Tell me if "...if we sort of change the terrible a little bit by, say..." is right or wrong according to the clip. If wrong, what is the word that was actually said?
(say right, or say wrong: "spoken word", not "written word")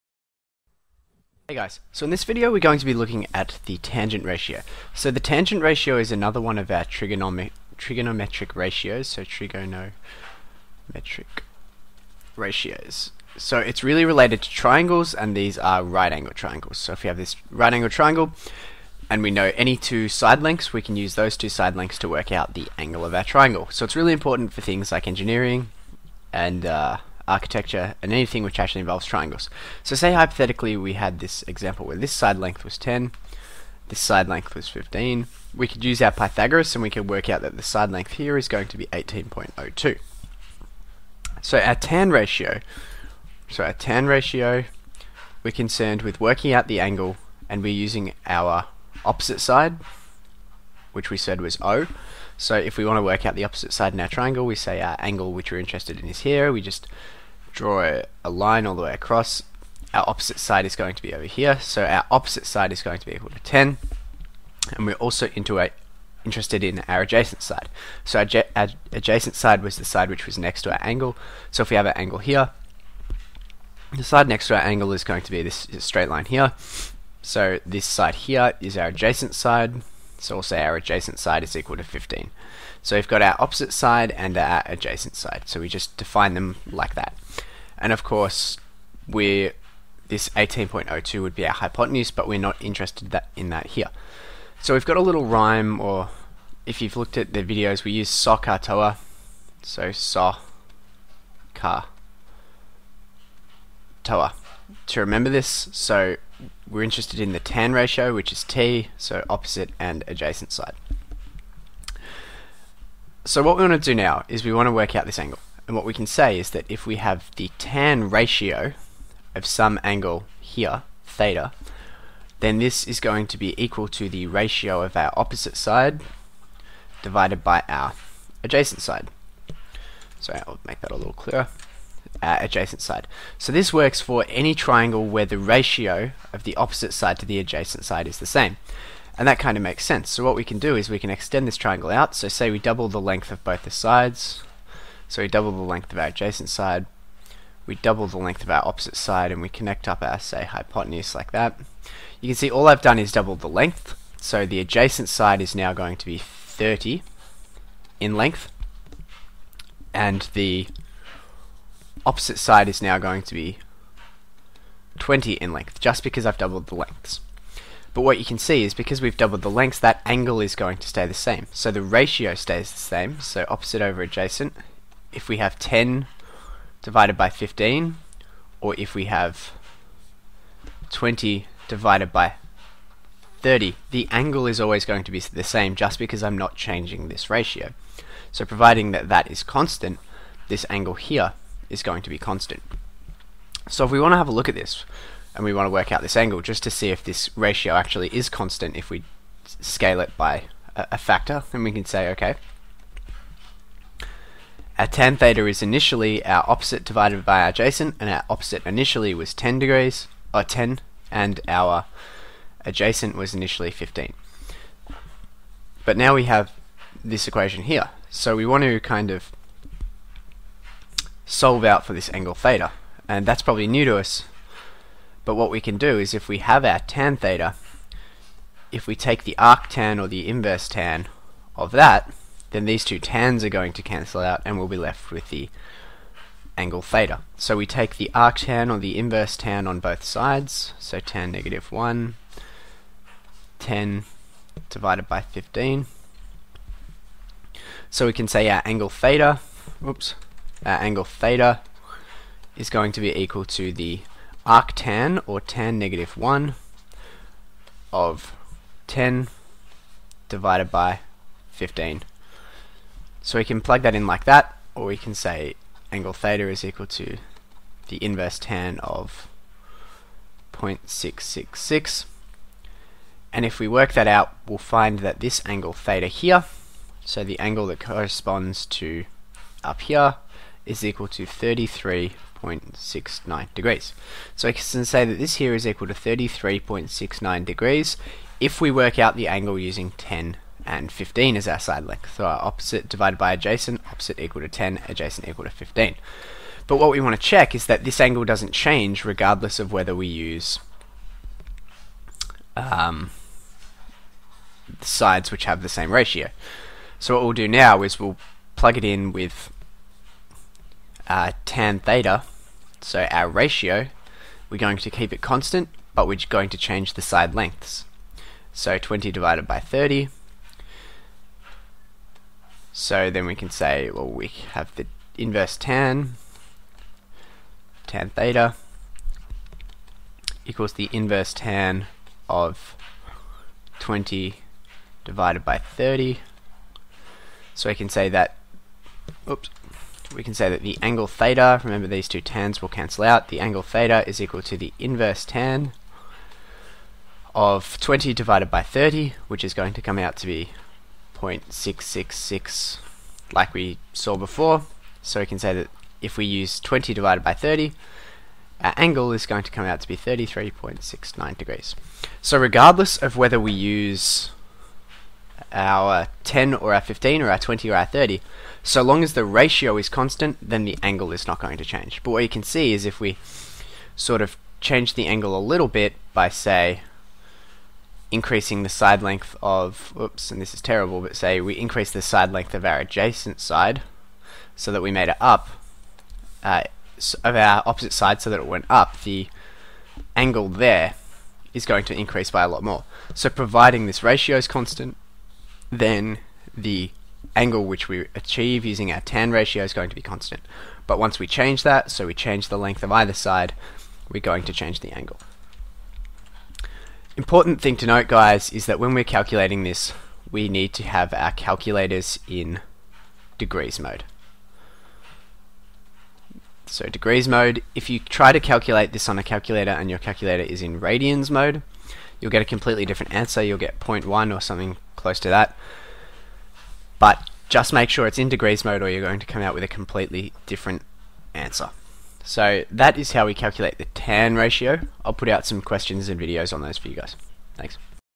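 wrong: "angle", not "terrible".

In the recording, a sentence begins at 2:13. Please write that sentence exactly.
So this works for any triangle where the ratio of the opposite side to the adjacent side is the same.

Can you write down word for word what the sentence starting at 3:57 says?
So we take the arctan or the inverse tan on both sides, so tan negative 1, 10 divided by 15.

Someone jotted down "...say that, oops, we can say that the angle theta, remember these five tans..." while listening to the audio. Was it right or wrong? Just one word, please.
wrong.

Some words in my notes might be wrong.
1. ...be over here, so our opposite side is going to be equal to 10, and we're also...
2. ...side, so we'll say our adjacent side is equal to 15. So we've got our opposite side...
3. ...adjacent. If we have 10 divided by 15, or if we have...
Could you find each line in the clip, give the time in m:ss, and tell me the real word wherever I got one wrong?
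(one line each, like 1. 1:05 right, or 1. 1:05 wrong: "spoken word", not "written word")
1. 1:01 right
2. 1:19 right
3. 2:54 right.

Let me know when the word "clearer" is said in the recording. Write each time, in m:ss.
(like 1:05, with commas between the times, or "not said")
2:11.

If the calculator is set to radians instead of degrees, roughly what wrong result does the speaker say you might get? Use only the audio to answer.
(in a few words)
0.1.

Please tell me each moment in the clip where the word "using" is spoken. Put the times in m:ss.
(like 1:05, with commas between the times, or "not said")
0:47, 4:49, 6:38.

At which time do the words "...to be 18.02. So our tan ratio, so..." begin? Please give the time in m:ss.
0:38.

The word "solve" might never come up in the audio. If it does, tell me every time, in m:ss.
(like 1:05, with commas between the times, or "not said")
3:41.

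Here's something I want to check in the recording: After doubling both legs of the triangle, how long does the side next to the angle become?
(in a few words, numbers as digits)
30.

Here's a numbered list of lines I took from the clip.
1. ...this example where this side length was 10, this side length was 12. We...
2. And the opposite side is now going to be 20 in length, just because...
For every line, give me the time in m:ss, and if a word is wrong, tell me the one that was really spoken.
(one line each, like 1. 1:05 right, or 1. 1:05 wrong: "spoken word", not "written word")
1. 0:31 wrong: "15", not "12"
2. 2:39 right.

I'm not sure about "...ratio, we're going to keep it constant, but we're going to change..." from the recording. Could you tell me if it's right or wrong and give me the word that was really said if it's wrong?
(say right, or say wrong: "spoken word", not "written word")
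right.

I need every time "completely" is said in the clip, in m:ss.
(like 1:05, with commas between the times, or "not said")
7:02, 7:09.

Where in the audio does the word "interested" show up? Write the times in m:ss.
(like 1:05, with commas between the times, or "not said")
0:55, 1:06, 1:32, 1:46.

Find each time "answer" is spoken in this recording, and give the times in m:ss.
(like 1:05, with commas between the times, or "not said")
7:03, 7:11.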